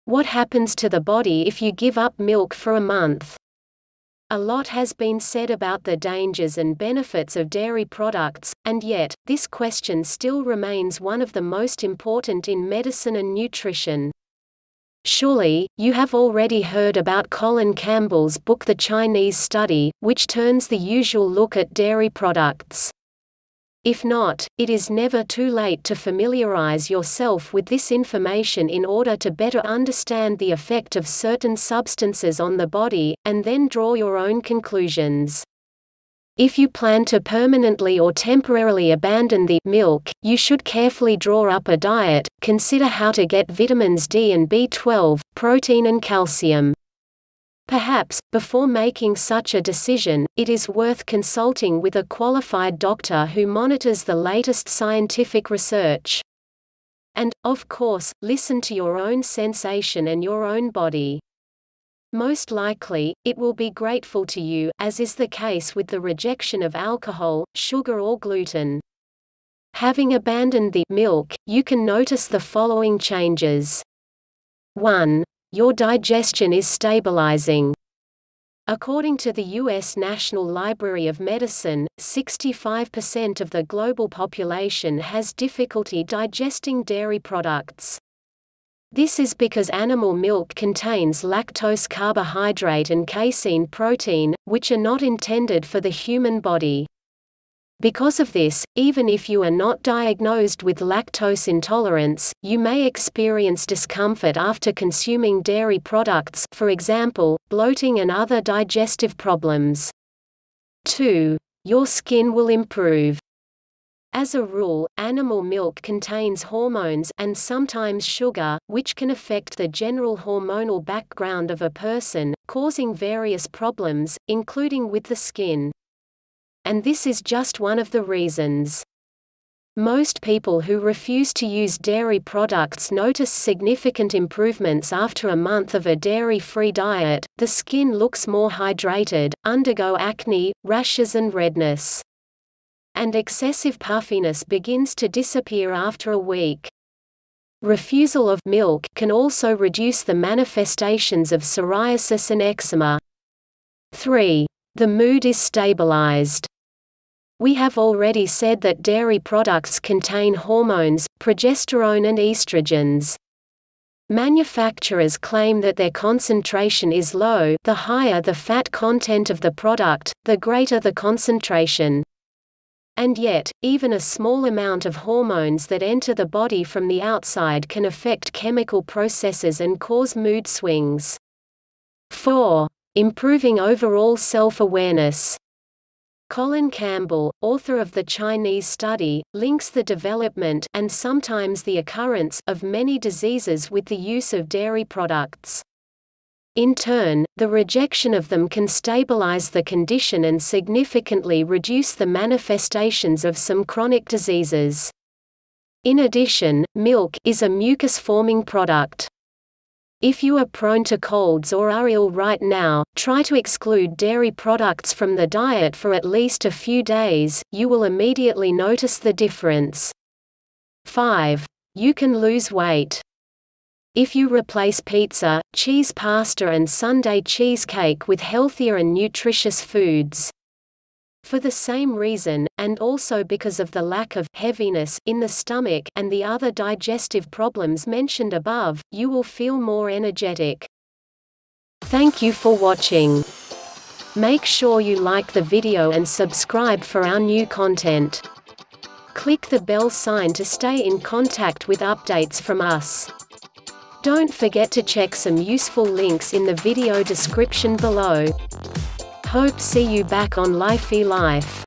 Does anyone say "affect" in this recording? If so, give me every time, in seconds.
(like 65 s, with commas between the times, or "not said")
119 s, 177 s.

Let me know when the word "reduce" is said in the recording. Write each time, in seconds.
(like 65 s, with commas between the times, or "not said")
149 s, 201 s.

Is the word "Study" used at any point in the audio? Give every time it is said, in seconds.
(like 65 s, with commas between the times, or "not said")
19 s, 188 s.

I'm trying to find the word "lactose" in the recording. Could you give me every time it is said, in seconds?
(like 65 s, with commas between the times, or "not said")
91 s, 100 s.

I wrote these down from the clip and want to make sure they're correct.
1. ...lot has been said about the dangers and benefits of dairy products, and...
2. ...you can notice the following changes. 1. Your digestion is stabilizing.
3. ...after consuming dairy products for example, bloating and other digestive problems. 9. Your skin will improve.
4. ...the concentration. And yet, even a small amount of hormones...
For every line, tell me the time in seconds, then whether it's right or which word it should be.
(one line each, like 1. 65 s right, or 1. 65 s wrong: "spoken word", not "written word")
1. 4 s right
2. 71 s right
3. 104 s wrong: "2", not "9"
4. 170 s right.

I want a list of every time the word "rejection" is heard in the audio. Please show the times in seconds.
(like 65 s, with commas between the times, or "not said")
66 s, 197 s.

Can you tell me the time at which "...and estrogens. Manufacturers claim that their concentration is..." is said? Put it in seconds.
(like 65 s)
162 s.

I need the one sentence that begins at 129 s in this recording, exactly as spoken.
Most people who refuse to use dairy products notice significant improvements after a month of a dairy free diet.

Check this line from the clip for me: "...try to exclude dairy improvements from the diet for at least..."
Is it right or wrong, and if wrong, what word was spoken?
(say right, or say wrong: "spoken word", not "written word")
wrong: "products", not "improvements".